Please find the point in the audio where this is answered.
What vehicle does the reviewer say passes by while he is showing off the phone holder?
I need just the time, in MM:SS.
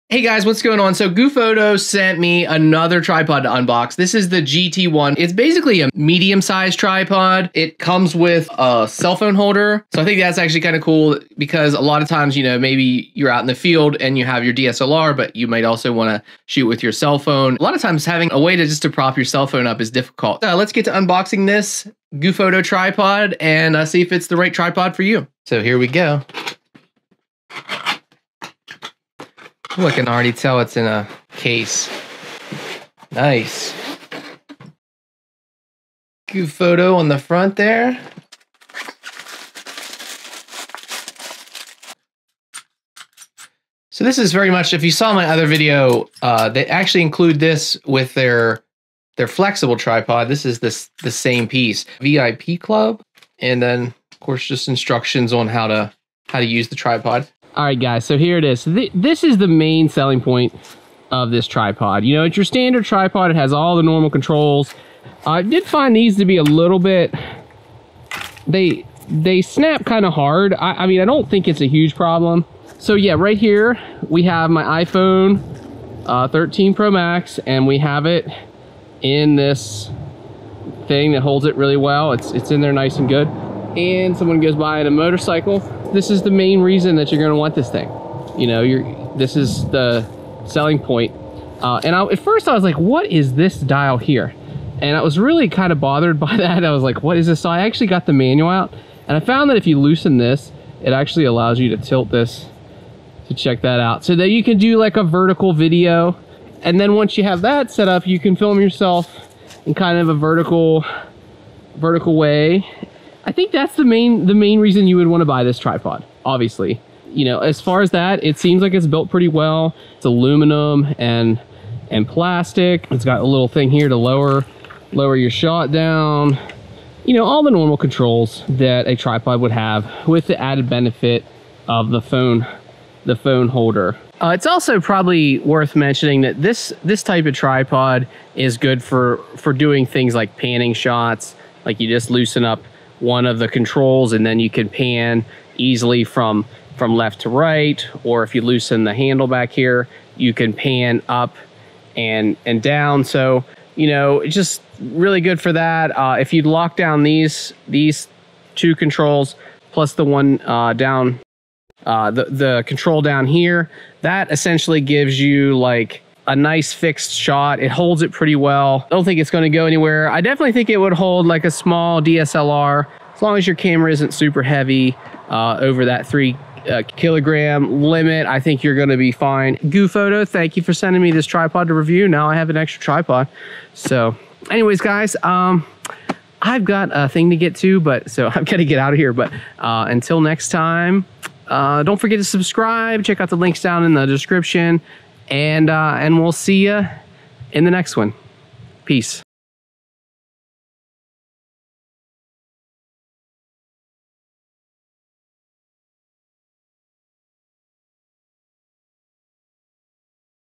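01:24.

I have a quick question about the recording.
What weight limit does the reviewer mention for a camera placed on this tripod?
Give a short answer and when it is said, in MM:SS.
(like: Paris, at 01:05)
3 kilograms, at 02:56.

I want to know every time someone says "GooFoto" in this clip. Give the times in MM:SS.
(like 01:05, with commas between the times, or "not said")
00:01, 00:22, 02:59.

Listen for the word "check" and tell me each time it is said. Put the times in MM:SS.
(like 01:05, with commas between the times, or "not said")
01:43, 03:13.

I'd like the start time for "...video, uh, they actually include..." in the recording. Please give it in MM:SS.
00:45.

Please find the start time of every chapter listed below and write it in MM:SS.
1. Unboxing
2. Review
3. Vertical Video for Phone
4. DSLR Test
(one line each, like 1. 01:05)
1. 00:25
2. 00:58
3. 01:38
4. 02:52.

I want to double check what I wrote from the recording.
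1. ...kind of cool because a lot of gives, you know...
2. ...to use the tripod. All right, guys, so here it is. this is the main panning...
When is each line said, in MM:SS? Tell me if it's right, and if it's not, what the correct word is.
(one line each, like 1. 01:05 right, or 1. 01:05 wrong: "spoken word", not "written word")
1. 00:10 wrong: "times", not "gives"
2. 00:56 wrong: "selling", not "panning".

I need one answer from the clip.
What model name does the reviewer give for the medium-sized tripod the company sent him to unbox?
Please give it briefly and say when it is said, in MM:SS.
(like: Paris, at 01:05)
GT1, at 00:04.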